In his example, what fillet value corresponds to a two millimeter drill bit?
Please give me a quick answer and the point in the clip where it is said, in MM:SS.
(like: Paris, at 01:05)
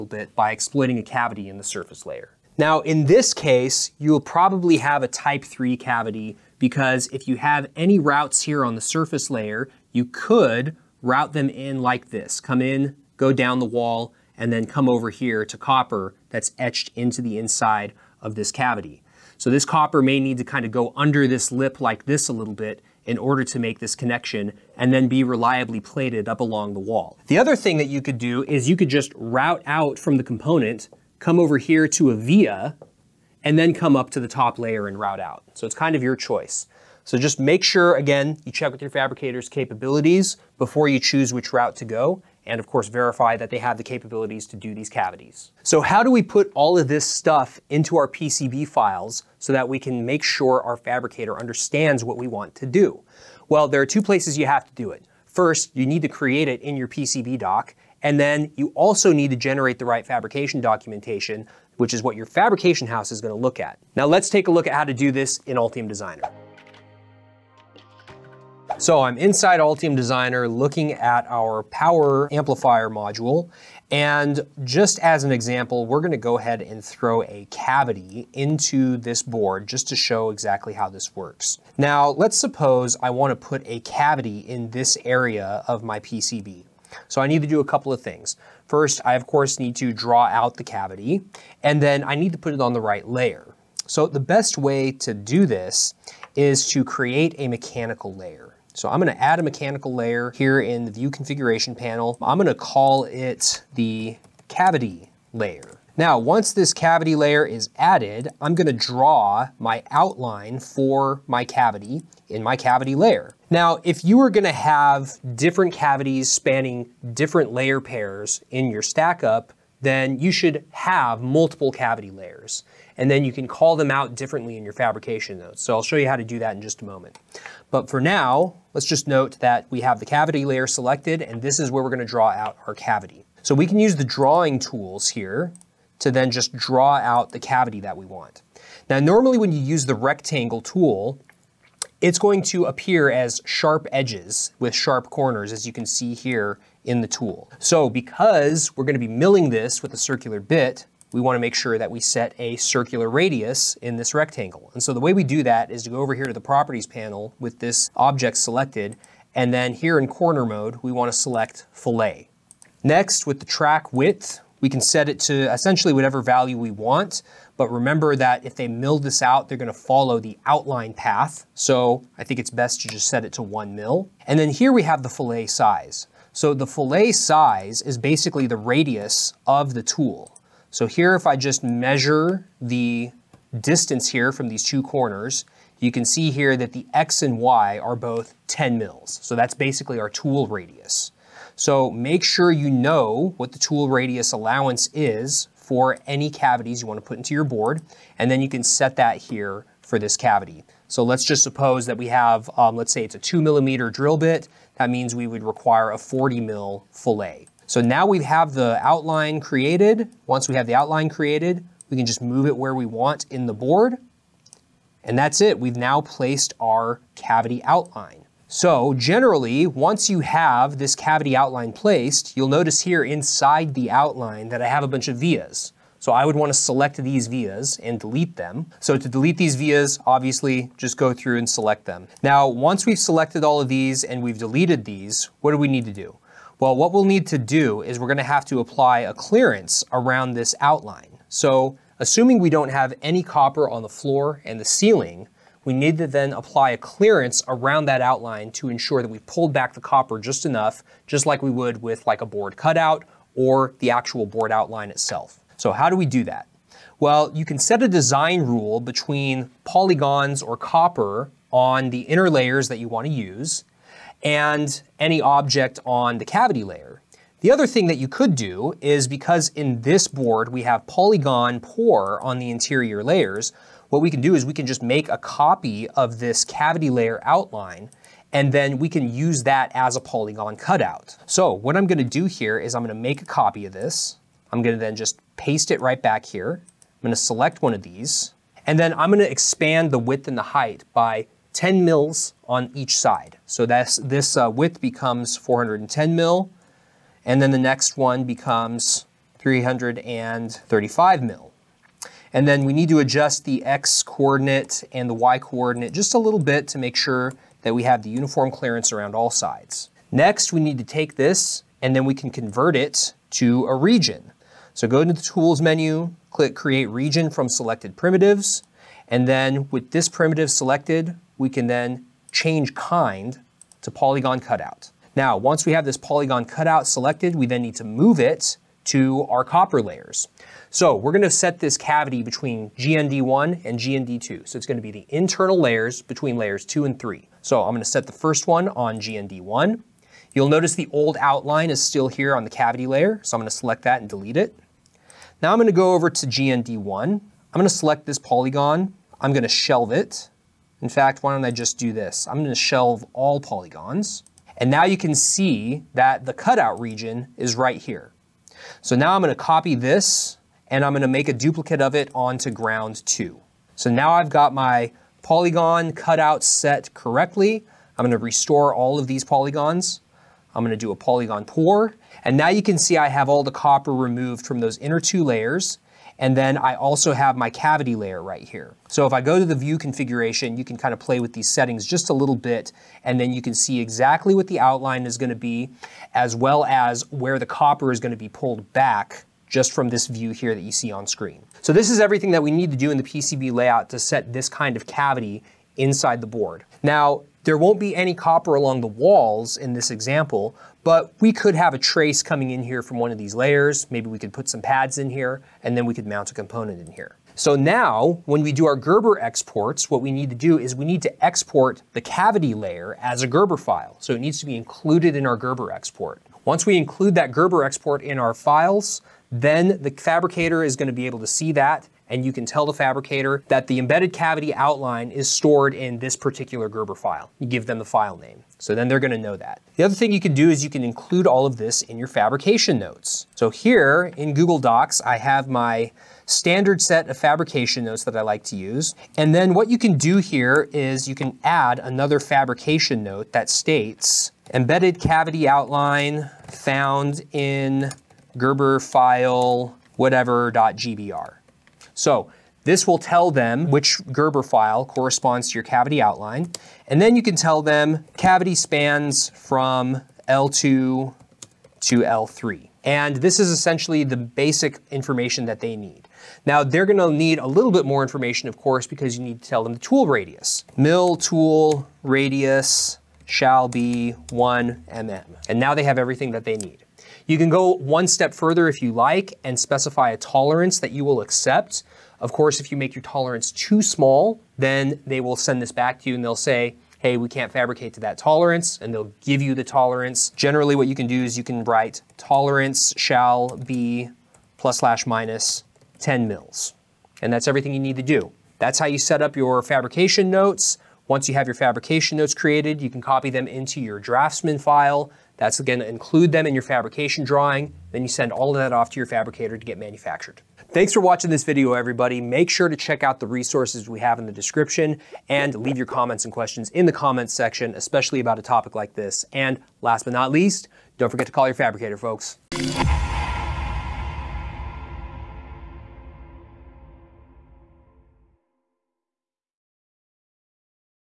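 40 mil, at 03:25.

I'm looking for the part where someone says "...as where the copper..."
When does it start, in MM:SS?
06:26.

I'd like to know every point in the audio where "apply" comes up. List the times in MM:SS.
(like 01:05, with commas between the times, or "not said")
03:58, 04:06.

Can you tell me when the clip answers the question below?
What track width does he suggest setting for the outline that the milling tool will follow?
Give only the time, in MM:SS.
02:53.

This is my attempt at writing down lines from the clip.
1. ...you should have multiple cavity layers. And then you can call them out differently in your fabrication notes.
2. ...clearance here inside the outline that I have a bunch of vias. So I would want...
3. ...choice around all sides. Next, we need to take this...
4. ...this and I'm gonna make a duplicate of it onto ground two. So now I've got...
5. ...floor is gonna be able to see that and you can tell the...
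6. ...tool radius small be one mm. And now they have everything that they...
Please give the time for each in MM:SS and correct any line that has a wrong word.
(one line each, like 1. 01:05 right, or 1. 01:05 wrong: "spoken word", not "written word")
1. 02:00 right
2. 03:42 wrong: "notice", not "clearance"
3. 05:08 wrong: "clearance", not "choice"
4. 05:59 right
5. 06:59 wrong: "fabricator", not "floor"
6. 07:51 wrong: "shall", not "small".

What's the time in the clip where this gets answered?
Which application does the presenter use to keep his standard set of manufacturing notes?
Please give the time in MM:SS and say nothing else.
07:14.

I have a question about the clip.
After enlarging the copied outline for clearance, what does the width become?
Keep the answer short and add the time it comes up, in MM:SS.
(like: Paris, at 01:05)
410 mil, at 04:55.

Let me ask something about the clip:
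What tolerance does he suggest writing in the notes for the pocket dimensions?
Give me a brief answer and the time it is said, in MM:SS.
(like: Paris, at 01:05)
+/- 10 mils, at 08:14.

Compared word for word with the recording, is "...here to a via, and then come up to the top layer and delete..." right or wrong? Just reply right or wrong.
wrong.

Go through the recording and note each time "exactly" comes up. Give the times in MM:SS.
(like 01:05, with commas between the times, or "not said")
01:20, 06:23.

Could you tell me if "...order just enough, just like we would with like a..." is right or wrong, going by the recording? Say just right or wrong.
wrong.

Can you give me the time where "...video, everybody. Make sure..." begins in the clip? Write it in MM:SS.
08:31.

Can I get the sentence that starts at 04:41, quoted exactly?
So what I'm gonna do here is I'm gonna make a copy of this.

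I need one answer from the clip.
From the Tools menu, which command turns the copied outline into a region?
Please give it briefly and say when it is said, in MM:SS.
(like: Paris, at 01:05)
create region from selected primitives, at 05:16.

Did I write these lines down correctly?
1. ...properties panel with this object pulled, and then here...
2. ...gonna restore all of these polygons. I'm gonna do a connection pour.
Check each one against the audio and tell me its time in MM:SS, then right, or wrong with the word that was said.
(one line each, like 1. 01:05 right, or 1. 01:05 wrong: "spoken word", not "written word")
1. 02:36 wrong: "selected", not "pulled"
2. 06:08 wrong: "polygon", not "connection".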